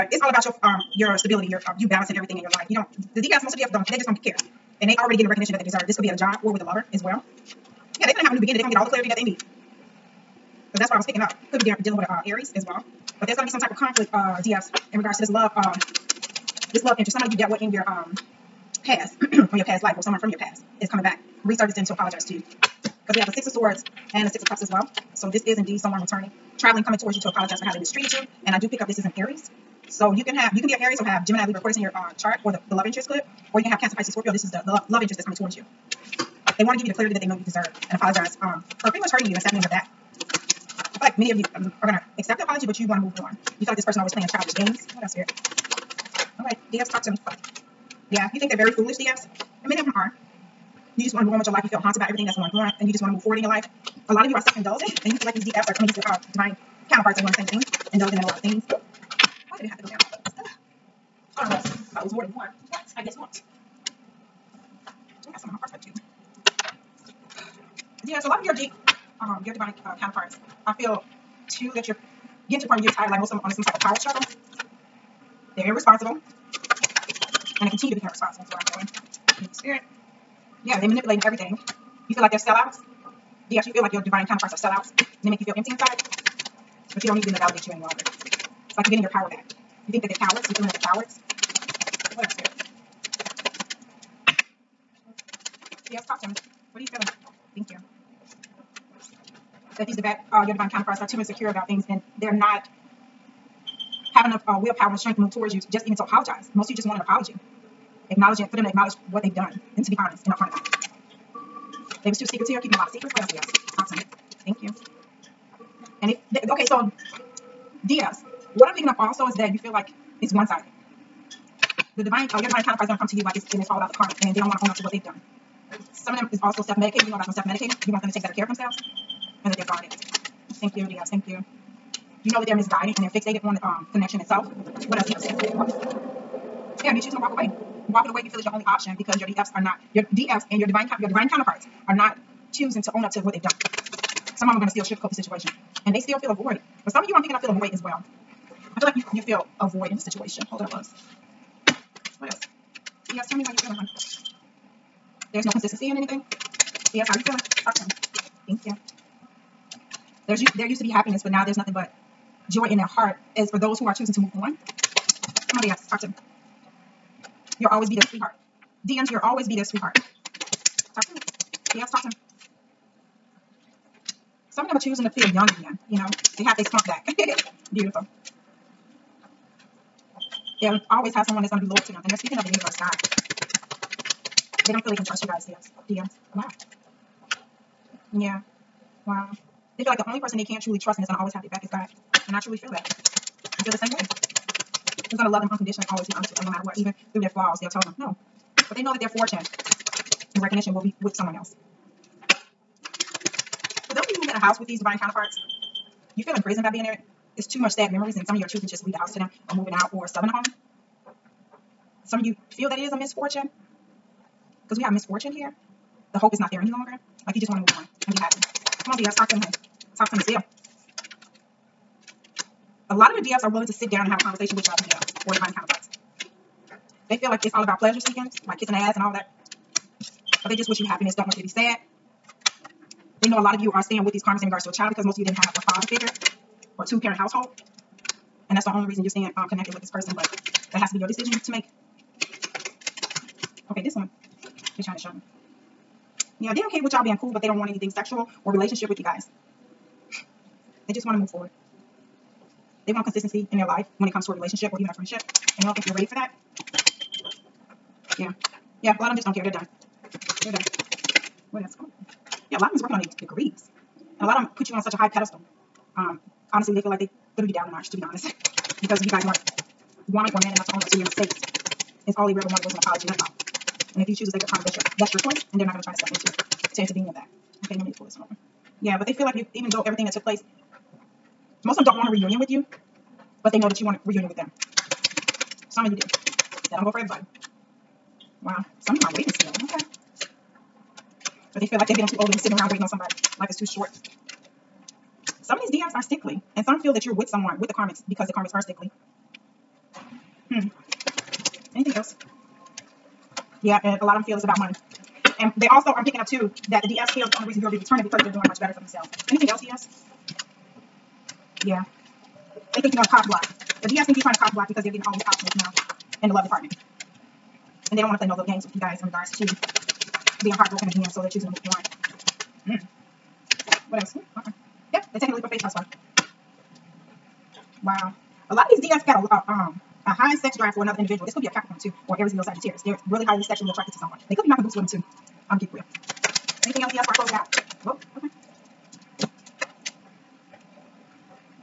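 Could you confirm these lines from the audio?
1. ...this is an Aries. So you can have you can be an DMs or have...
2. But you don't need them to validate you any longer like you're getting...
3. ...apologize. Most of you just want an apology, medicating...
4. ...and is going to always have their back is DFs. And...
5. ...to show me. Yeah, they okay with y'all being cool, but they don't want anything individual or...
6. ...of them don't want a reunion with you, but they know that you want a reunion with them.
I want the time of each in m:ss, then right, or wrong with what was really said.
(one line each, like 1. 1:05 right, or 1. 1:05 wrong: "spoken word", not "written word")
1. 0:28 wrong: "Aries", not "DMs"
2. 1:26 right
3. 1:46 wrong: "acknowledging", not "medicating"
4. 3:10 wrong: "God", not "DFs"
5. 4:04 wrong: "sexual", not "individual"
6. 4:41 right.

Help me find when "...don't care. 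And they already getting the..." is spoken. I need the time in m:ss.
0:04.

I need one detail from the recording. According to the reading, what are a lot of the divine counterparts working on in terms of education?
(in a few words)
Their degrees.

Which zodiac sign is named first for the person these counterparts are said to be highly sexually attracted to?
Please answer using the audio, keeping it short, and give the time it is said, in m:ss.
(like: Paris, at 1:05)
Capricorn, at 5:31.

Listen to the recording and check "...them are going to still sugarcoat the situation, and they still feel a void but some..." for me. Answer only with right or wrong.
right.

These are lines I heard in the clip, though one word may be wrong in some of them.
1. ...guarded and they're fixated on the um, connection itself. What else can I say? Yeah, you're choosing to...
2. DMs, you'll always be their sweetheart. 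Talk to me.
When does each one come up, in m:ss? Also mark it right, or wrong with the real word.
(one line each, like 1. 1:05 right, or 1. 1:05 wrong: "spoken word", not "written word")
1. 2:12 wrong: "misguided", not "guarded"
2. 2:48 right.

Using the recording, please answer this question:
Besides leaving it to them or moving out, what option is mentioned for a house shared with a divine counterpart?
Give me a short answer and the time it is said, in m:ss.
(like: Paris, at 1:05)
Selling the home, at 3:30.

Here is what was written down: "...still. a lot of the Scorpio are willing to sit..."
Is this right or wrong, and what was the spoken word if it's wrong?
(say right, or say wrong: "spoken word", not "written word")
wrong: "DFs", not "Scorpio".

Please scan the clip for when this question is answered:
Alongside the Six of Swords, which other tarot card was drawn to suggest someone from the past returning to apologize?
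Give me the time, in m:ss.
0:24.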